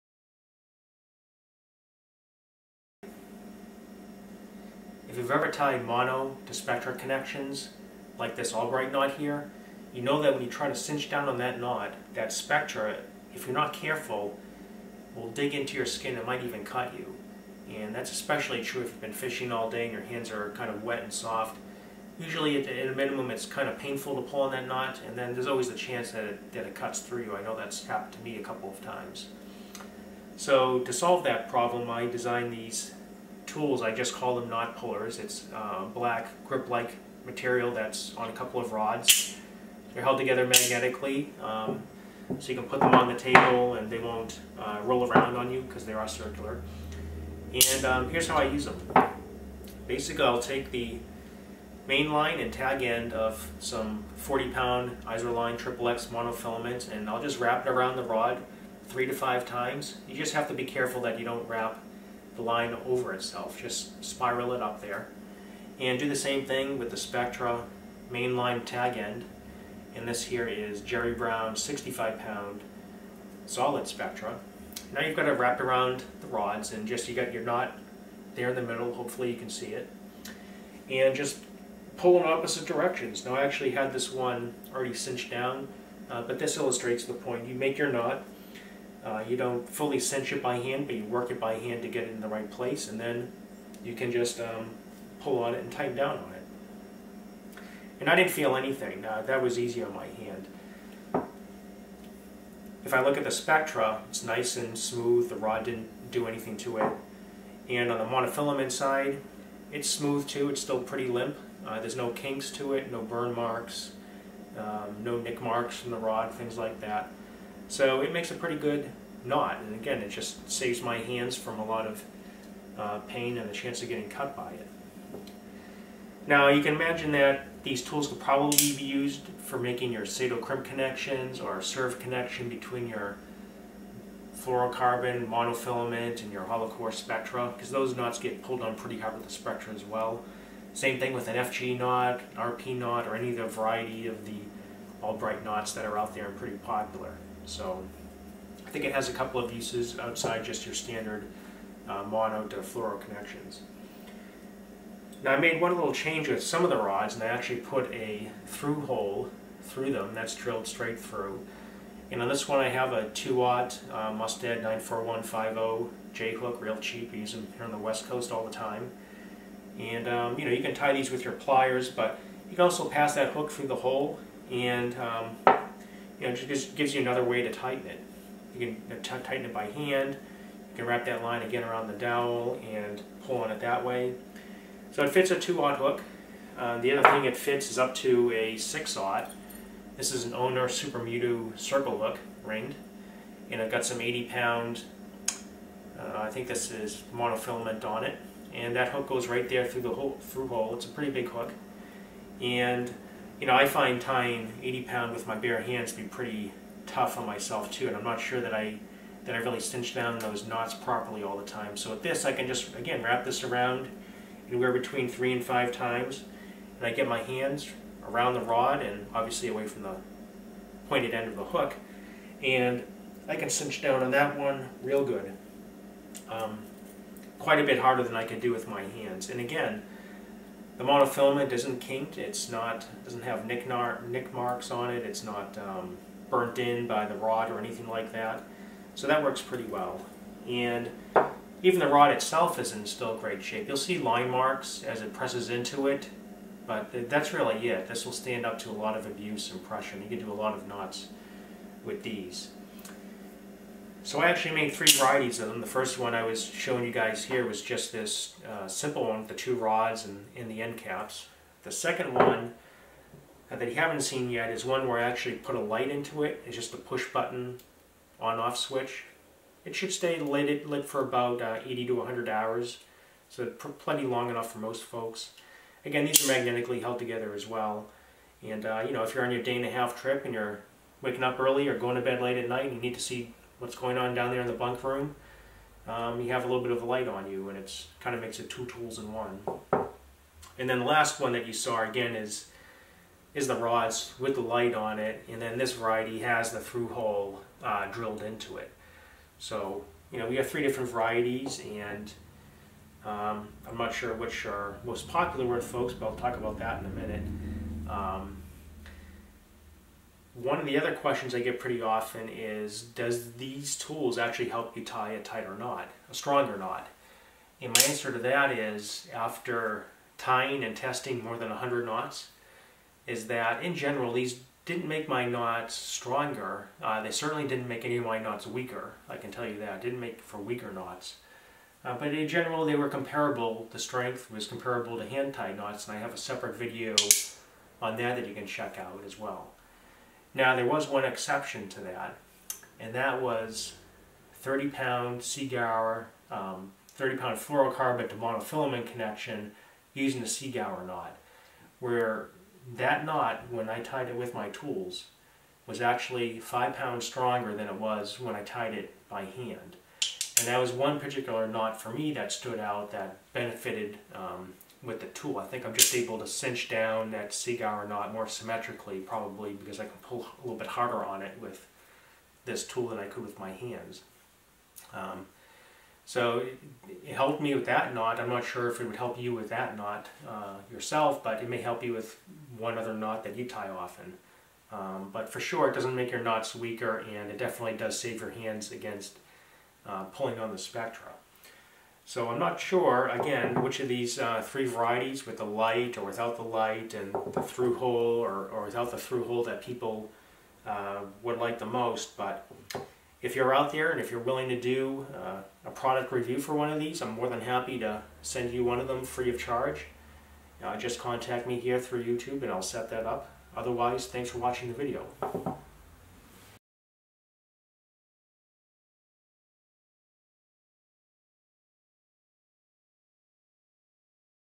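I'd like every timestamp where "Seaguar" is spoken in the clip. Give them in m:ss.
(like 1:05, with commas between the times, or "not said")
5:45, 5:50, 6:07.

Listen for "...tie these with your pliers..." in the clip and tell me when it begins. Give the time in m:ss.
2:50.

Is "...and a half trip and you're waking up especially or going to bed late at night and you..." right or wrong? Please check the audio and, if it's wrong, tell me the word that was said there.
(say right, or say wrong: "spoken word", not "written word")
wrong: "early", not "especially".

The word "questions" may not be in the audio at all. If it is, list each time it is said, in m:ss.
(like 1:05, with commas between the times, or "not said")
5:10.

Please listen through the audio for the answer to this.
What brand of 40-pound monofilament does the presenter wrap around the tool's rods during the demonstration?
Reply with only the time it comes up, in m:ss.
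0:55.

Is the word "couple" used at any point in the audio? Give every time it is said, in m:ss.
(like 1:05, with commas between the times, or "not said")
0:28, 0:38, 2:29.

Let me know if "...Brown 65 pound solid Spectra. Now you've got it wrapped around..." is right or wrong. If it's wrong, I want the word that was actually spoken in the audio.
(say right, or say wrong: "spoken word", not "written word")
right.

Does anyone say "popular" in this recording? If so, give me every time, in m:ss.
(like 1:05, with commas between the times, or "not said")
2:26, 5:05.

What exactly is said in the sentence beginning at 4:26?
It's just a push button on-off switch.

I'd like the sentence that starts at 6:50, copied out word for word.
Uh, just contact me here through YouTube and I'll set that up.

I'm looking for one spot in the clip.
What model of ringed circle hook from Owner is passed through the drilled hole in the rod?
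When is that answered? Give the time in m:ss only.
3:10.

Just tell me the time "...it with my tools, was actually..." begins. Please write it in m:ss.
5:54.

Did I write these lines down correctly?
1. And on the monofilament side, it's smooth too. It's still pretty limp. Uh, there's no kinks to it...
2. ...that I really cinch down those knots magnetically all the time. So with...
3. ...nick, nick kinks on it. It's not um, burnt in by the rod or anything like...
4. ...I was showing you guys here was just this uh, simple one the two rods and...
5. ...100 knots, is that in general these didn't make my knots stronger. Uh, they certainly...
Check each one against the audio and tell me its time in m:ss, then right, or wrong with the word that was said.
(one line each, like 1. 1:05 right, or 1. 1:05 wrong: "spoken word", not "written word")
1. 1:47 right
2. 3:29 wrong: "properly", not "magnetically"
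3. 3:53 wrong: "marks", not "kinks"
4. 4:16 right
5. 5:21 right.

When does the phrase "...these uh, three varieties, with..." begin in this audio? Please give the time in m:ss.
6:33.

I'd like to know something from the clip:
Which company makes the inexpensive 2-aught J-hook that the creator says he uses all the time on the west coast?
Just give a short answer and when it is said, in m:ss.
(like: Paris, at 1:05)
Mustad, at 2:44.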